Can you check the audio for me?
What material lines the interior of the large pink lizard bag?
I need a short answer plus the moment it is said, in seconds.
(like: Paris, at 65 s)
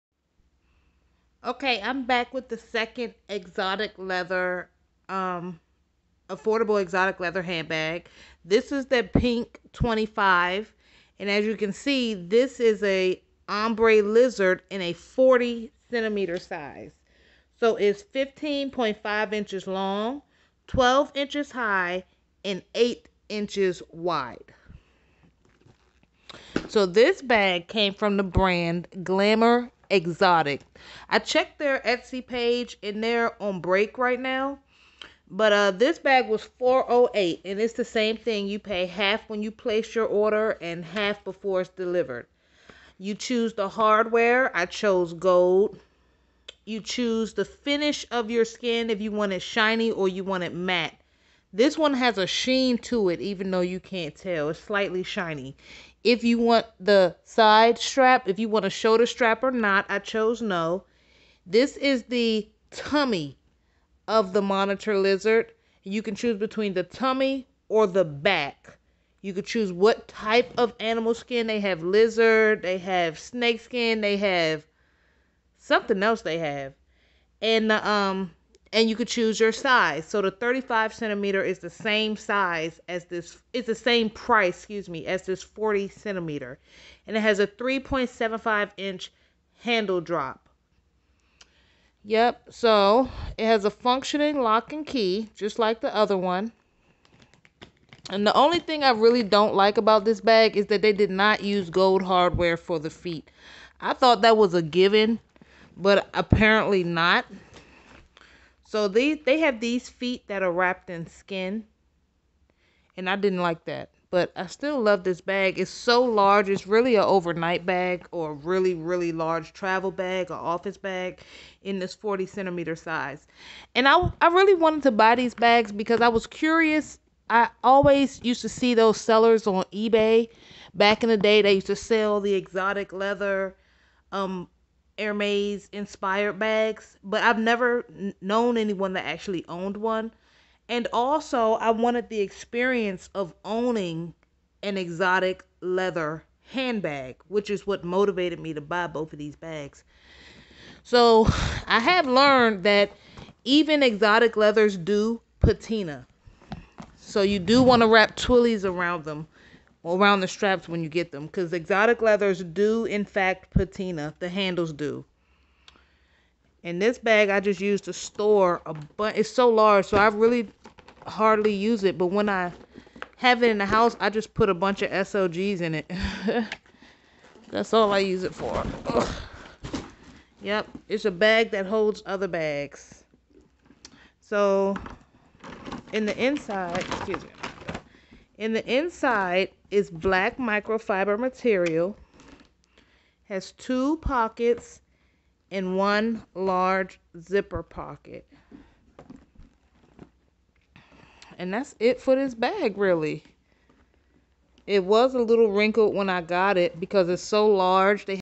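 black microfiber, at 189 s.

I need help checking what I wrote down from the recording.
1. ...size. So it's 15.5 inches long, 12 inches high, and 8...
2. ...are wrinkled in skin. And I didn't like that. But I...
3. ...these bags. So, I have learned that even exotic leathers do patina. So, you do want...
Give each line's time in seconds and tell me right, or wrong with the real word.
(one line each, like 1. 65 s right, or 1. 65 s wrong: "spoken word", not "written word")
1. 16 s right
2. 110 s wrong: "wrapped", not "wrinkled"
3. 149 s right.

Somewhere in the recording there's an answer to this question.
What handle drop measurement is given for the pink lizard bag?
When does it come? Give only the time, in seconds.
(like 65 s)
87 s.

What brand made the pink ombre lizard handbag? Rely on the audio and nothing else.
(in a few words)
Glamour Exotic.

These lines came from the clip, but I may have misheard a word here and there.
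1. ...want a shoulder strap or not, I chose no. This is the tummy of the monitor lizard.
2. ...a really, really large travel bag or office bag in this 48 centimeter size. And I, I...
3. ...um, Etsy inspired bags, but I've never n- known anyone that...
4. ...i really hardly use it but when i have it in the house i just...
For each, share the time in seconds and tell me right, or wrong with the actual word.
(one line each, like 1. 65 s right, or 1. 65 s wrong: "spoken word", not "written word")
1. 58 s right
2. 118 s wrong: "40", not "48"
3. 134 s wrong: "Hermes", not "Etsy"
4. 169 s right.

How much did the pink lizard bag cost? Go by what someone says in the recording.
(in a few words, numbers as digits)
408.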